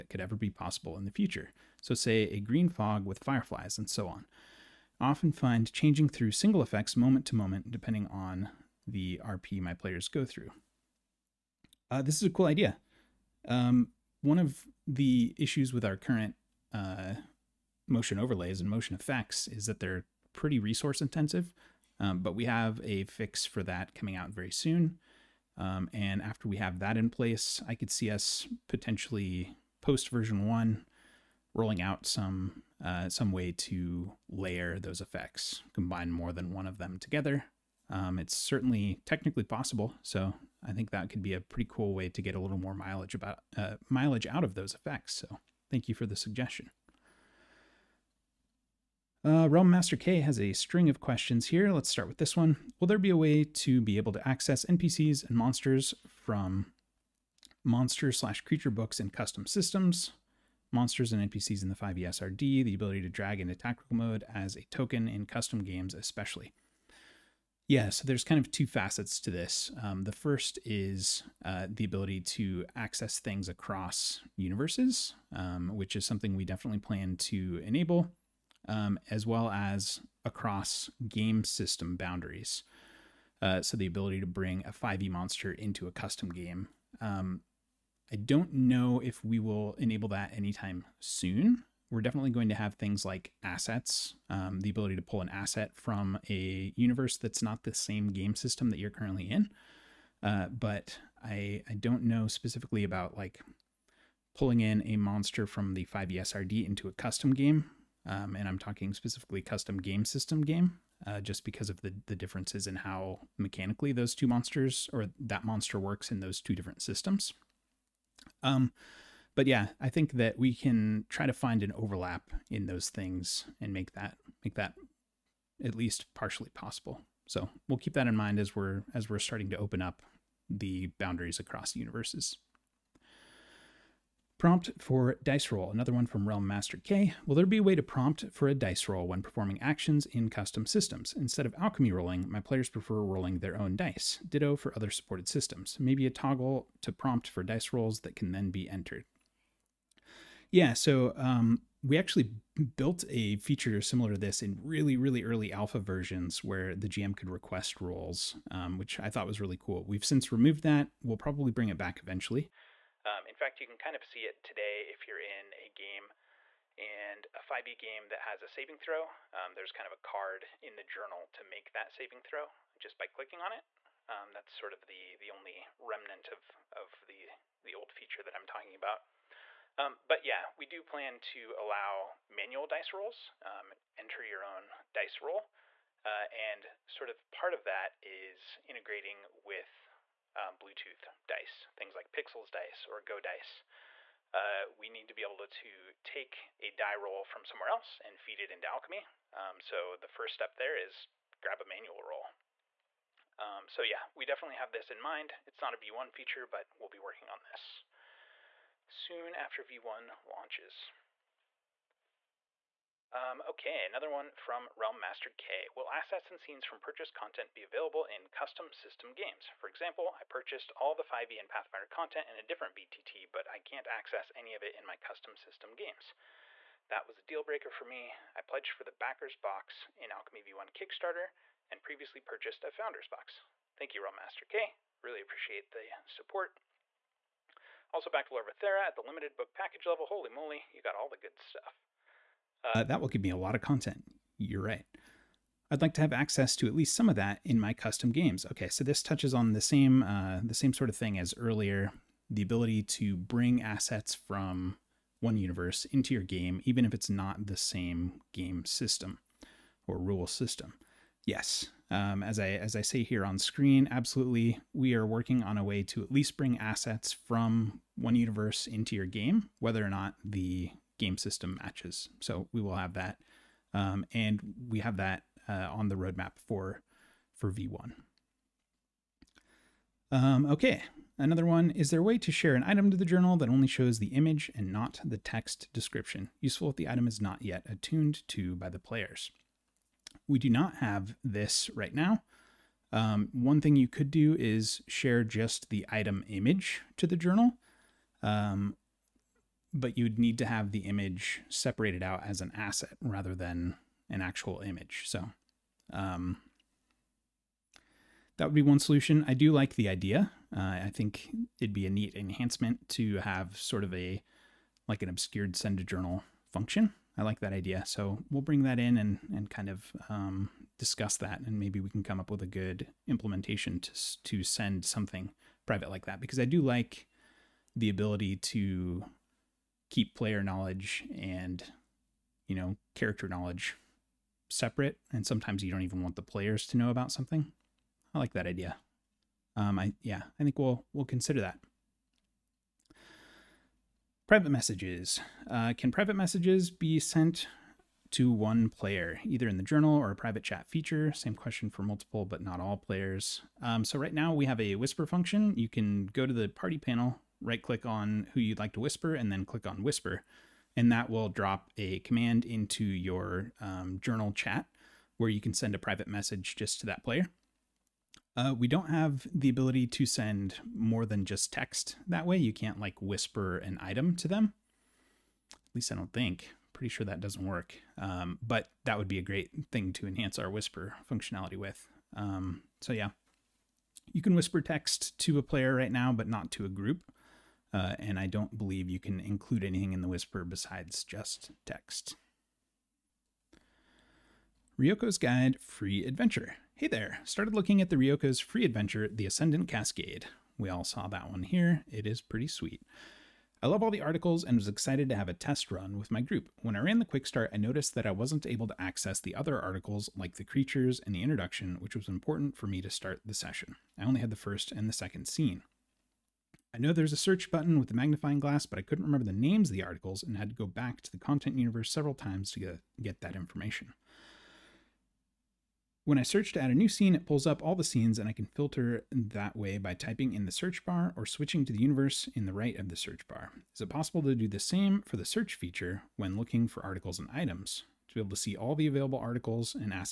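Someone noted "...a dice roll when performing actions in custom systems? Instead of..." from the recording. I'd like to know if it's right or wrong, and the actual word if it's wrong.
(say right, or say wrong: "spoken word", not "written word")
right.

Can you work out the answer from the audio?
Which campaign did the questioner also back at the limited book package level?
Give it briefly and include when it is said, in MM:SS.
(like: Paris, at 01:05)
Larvathera, at 03:58.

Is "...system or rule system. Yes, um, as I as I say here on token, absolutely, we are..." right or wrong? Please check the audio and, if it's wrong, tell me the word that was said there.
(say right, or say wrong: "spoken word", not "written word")
wrong: "screen", not "token".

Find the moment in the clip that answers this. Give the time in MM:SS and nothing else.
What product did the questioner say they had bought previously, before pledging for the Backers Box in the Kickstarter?
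03:52.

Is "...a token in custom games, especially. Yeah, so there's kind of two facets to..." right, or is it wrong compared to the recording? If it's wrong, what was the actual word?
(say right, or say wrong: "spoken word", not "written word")
right.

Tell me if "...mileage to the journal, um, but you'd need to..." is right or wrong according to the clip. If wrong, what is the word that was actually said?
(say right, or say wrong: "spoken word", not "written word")
wrong: "image", not "mileage".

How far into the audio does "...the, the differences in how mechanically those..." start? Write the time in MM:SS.
01:51.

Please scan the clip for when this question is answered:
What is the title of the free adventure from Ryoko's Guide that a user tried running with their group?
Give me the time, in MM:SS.
06:39.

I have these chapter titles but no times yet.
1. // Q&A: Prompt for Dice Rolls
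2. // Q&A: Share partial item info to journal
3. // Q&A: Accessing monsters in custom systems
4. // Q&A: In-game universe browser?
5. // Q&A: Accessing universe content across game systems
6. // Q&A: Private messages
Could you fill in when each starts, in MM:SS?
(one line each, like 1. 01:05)
1. 02:11
2. 04:40
3. 00:46
4. 06:32
5. 03:31
6. 05:43.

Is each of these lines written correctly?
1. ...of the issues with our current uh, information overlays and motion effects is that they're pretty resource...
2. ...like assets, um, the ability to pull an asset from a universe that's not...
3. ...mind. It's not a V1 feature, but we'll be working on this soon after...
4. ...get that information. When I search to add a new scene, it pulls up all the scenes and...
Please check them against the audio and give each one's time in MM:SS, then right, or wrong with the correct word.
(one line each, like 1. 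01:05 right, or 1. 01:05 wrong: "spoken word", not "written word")
1. 00:14 wrong: "motion", not "information"
2. 01:33 right
3. 03:24 right
4. 07:03 right.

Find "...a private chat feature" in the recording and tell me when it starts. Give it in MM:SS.
05:50.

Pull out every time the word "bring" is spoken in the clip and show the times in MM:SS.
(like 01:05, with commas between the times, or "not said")
01:24, 02:41, 04:13, 04:26, 05:18.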